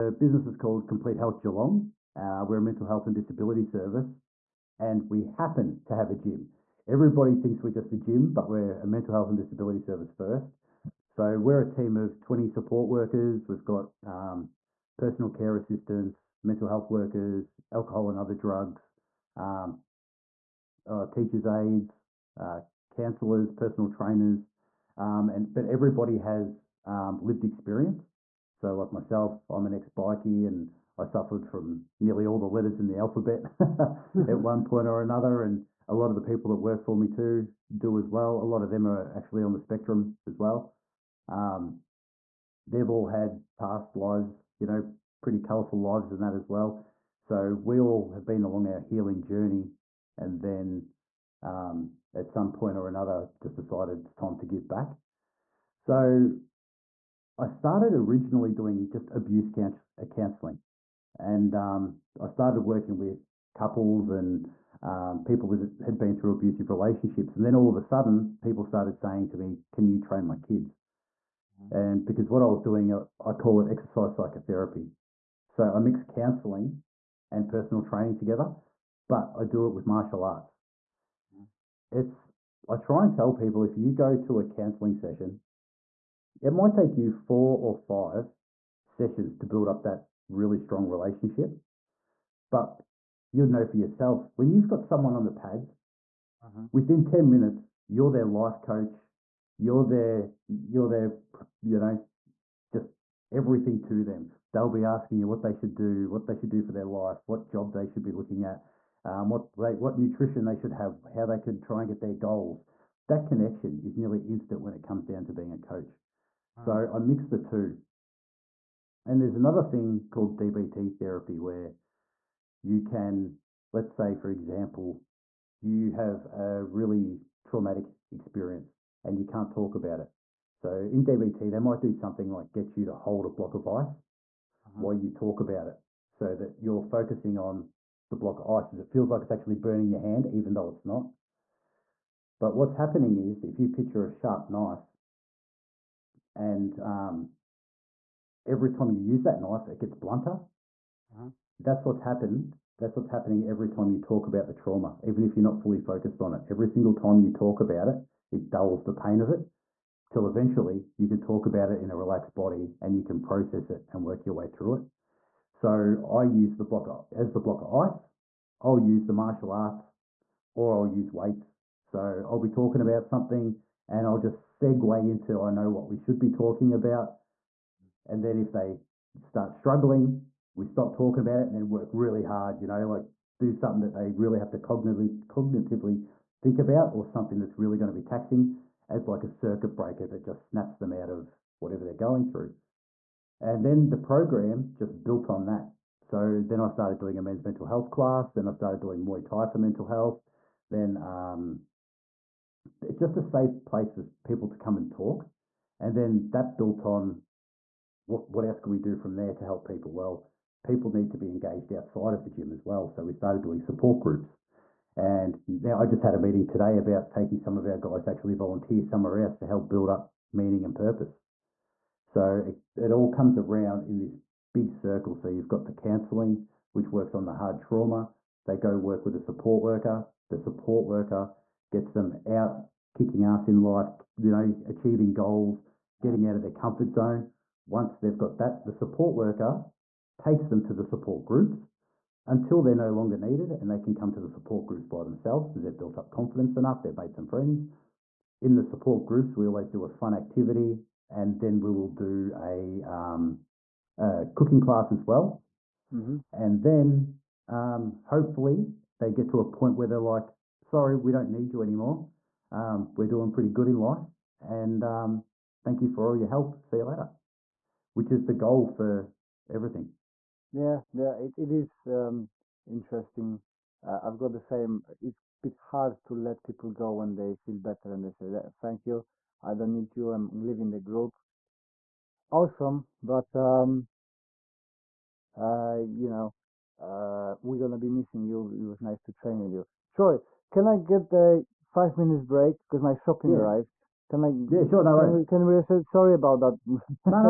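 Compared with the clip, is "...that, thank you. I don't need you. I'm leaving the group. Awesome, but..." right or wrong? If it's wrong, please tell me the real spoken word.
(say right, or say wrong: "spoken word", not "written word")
right.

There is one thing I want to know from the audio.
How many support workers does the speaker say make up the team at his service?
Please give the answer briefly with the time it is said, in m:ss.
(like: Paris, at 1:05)
20, at 0:12.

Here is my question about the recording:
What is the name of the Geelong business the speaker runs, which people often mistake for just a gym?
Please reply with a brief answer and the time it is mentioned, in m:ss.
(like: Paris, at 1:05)
Complete Health Geelong, at 0:00.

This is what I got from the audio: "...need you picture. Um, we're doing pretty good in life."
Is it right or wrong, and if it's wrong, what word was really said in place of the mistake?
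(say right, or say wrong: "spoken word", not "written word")
wrong: "anymore", not "picture".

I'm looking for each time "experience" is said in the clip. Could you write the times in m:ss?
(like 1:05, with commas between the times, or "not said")
0:27, 2:08.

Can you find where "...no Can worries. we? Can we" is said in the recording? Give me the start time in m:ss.
4:54.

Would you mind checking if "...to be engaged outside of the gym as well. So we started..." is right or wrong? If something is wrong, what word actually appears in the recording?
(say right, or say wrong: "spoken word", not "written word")
right.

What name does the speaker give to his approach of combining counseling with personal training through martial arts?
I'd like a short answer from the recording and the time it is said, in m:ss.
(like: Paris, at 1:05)
exercise psychotherapy, at 1:13.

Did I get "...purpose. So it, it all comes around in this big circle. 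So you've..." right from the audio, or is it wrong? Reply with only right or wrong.
right.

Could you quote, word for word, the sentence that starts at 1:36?
within 10 minutes, you're their life coach, you're their you're their you know, just everything to them.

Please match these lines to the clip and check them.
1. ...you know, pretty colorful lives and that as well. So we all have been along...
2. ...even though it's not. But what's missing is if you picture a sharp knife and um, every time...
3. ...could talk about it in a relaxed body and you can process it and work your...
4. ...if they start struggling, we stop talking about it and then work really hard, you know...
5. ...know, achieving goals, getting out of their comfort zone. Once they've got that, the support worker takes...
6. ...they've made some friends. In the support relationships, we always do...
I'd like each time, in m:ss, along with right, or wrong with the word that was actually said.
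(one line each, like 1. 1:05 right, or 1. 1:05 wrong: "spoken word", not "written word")
1. 0:44 right
2. 2:20 wrong: "happening", not "missing"
3. 2:41 right
4. 2:58 right
5. 3:54 right
6. 4:06 wrong: "groups", not "relationships".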